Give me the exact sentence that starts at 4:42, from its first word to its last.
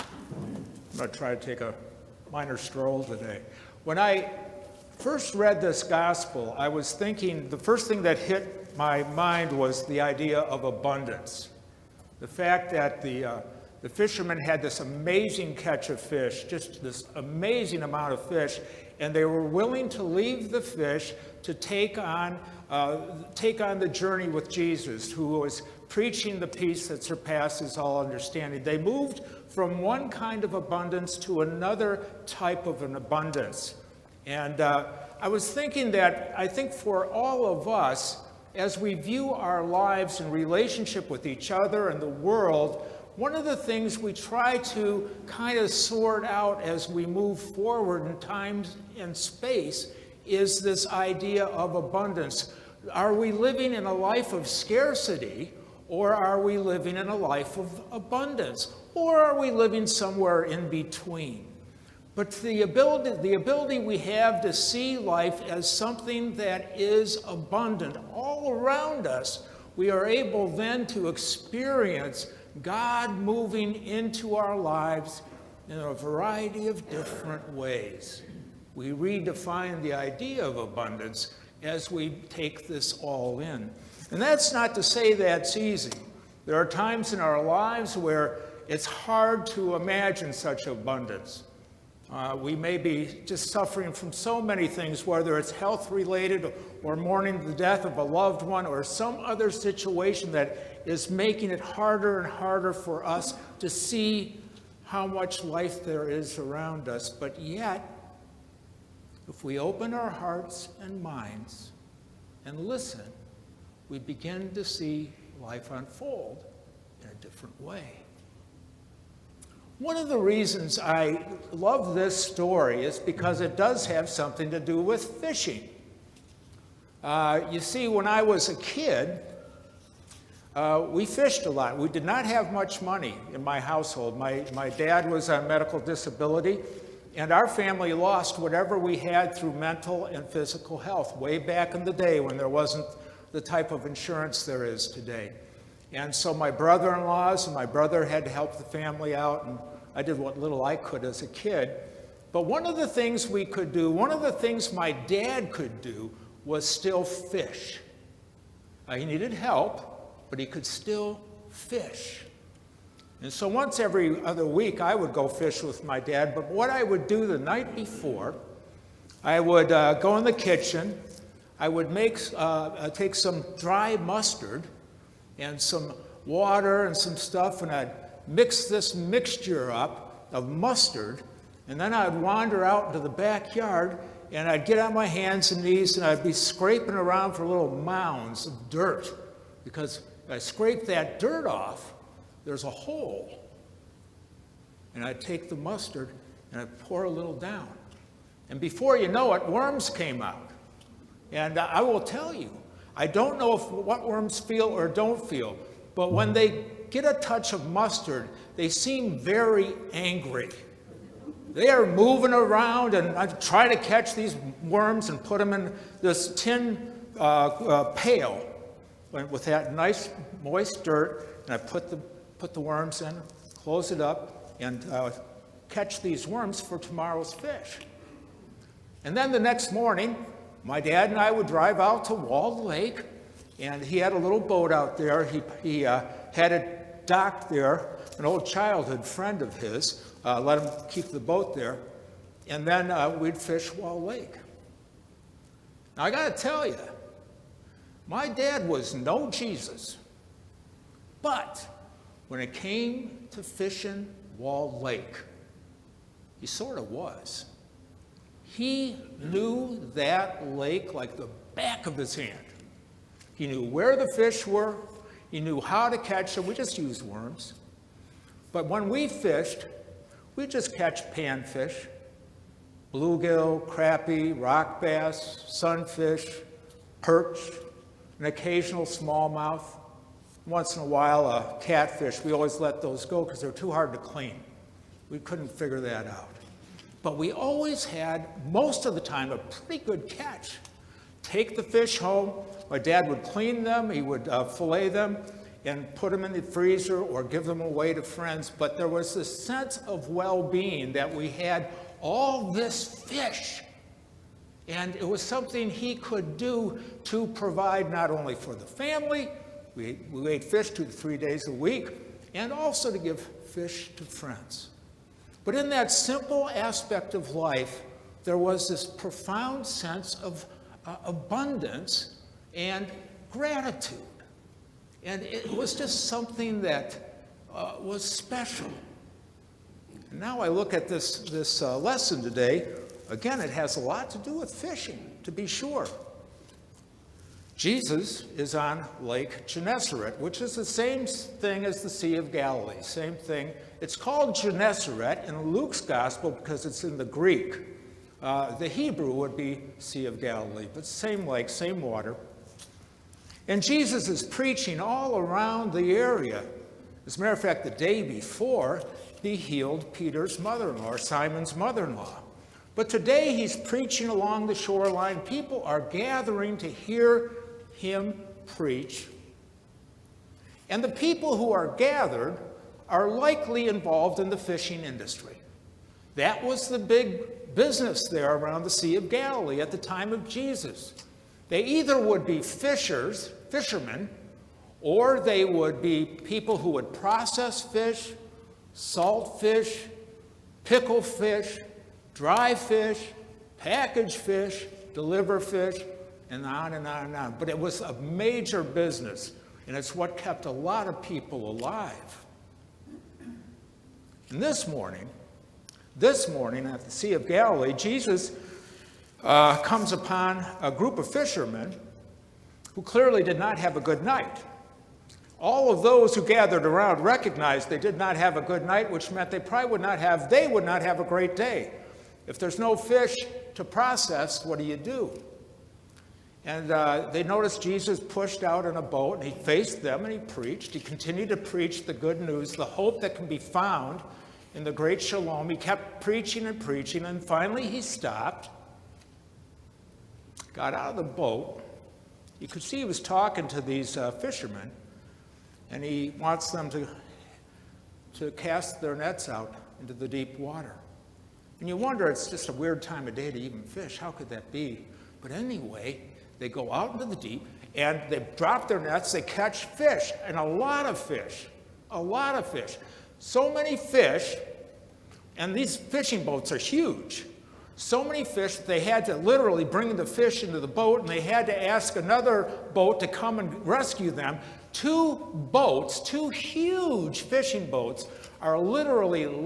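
We always let those go because they're too hard to clean.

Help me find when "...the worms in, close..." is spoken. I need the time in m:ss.
3:42.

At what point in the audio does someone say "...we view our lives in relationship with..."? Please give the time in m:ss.
0:38.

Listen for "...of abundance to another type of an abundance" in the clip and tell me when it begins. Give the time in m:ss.
0:30.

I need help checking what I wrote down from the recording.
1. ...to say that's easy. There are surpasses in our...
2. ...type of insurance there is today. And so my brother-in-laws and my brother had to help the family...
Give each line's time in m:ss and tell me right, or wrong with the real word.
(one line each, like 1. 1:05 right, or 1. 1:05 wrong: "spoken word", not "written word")
1. 1:24 wrong: "times", not "surpasses"
2. 2:23 right.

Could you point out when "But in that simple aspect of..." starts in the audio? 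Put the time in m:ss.
5:15.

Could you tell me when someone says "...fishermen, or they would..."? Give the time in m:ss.
6:23.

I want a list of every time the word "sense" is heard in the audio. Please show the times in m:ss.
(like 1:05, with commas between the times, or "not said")
4:59, 5:19.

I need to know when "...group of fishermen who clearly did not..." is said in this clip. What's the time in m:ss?
6:50.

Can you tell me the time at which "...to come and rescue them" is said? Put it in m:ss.
7:53.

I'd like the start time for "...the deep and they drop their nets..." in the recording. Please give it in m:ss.
7:37.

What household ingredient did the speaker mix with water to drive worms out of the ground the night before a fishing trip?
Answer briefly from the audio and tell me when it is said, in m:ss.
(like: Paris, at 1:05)
dry mustard, at 2:53.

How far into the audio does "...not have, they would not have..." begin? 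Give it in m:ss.
6:59.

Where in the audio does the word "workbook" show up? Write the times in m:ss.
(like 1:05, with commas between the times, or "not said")
not said.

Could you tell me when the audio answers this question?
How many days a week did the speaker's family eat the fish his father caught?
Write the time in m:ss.
5:10.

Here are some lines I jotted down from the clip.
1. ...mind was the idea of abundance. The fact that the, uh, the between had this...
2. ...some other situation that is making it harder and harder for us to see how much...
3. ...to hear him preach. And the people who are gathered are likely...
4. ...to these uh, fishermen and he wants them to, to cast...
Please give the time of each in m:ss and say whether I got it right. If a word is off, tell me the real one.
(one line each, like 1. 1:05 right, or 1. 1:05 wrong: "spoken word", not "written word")
1. 0:09 wrong: "fishermen", not "between"
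2. 1:38 right
3. 6:06 right
4. 7:23 right.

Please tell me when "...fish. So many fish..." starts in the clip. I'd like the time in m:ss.
7:42.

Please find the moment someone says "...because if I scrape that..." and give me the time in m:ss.
3:09.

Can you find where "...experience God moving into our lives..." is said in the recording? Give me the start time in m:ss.
1:11.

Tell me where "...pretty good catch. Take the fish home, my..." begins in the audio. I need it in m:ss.
4:49.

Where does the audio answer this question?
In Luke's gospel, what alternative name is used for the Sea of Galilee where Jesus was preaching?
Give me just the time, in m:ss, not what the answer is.
5:39.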